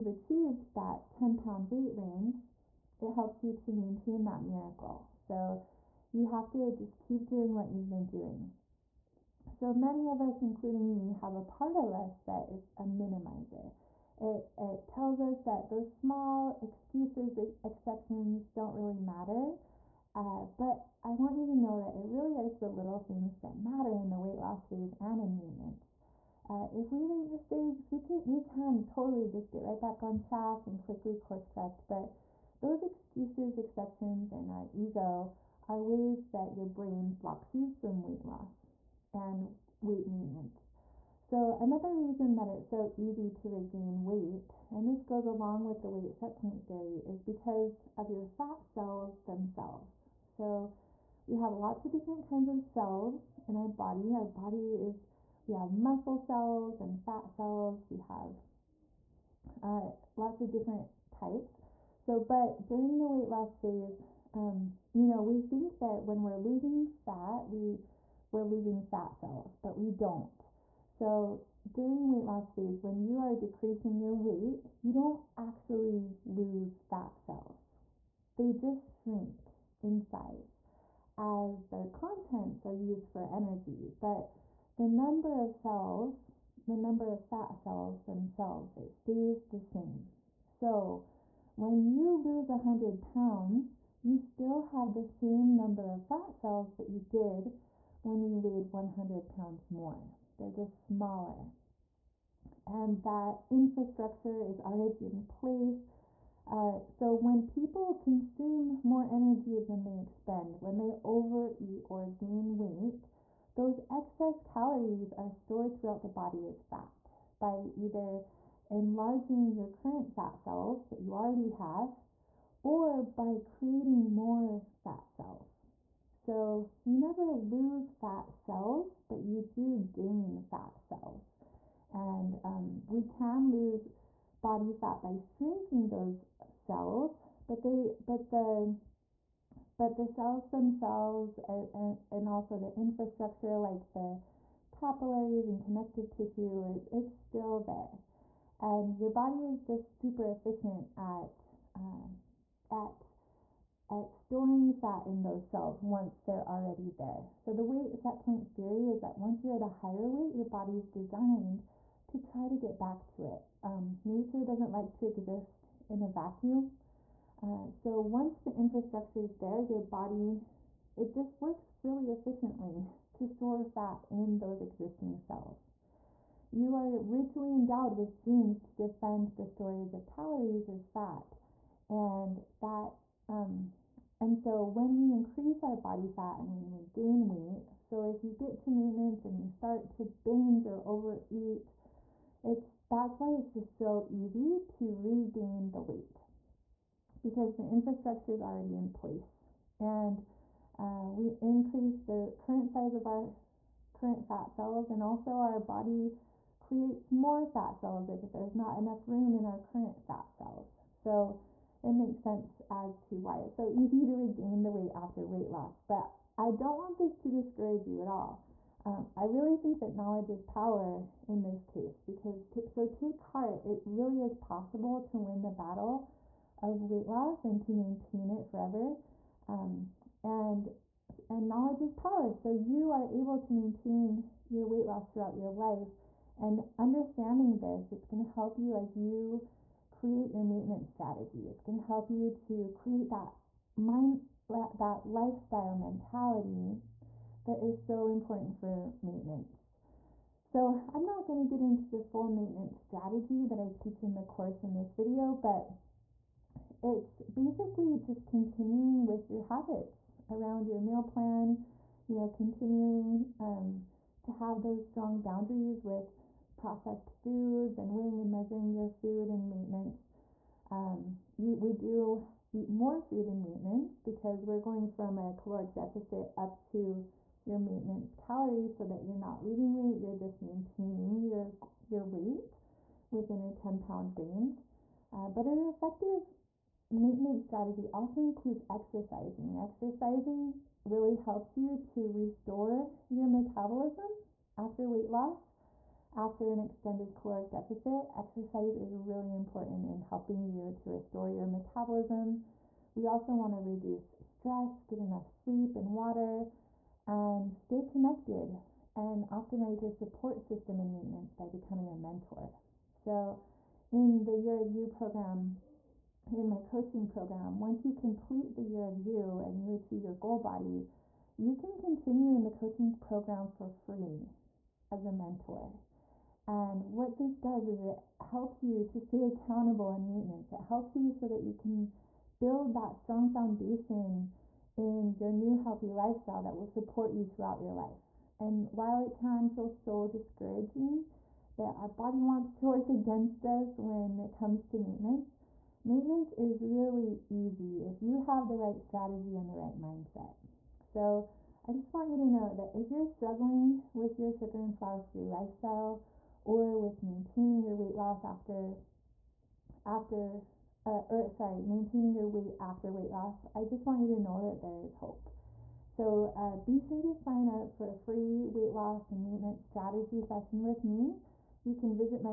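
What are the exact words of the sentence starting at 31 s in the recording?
But those excuses, exceptions, and our ego are ways that your brain blocks you from weight loss and weight maintenance.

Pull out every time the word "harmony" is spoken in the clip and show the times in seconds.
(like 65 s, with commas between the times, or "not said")
not said.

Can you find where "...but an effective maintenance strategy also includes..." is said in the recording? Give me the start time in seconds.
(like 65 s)
285 s.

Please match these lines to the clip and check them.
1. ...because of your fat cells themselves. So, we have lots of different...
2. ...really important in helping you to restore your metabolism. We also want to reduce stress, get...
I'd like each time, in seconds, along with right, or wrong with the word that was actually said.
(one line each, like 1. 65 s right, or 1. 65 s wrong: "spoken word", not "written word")
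1. 47 s right
2. 298 s right.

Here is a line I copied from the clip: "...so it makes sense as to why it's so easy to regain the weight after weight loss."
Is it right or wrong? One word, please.
right.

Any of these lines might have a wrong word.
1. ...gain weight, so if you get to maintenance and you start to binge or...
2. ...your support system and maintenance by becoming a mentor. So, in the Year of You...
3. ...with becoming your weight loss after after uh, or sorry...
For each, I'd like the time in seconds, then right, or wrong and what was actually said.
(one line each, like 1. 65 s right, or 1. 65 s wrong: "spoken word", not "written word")
1. 186 s right
2. 309 s right
3. 356 s wrong: "maintaining", not "becoming".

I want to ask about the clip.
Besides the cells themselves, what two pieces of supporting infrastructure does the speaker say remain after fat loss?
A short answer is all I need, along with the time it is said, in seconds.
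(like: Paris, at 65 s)
capillaries and connective tissue, at 144 s.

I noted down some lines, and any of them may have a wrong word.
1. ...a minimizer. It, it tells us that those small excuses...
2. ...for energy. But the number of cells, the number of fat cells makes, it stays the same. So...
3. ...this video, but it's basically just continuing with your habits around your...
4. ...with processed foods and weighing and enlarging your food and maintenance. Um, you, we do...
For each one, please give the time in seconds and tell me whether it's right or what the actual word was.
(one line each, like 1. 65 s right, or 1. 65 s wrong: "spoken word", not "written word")
1. 12 s right
2. 83 s wrong: "themselves", not "makes"
3. 254 s right
4. 265 s wrong: "measuring", not "enlarging".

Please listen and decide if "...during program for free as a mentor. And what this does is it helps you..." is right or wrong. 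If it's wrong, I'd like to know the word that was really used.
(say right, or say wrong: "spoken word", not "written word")
wrong: "coaching", not "during".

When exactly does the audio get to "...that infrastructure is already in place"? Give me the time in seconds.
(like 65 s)
103 s.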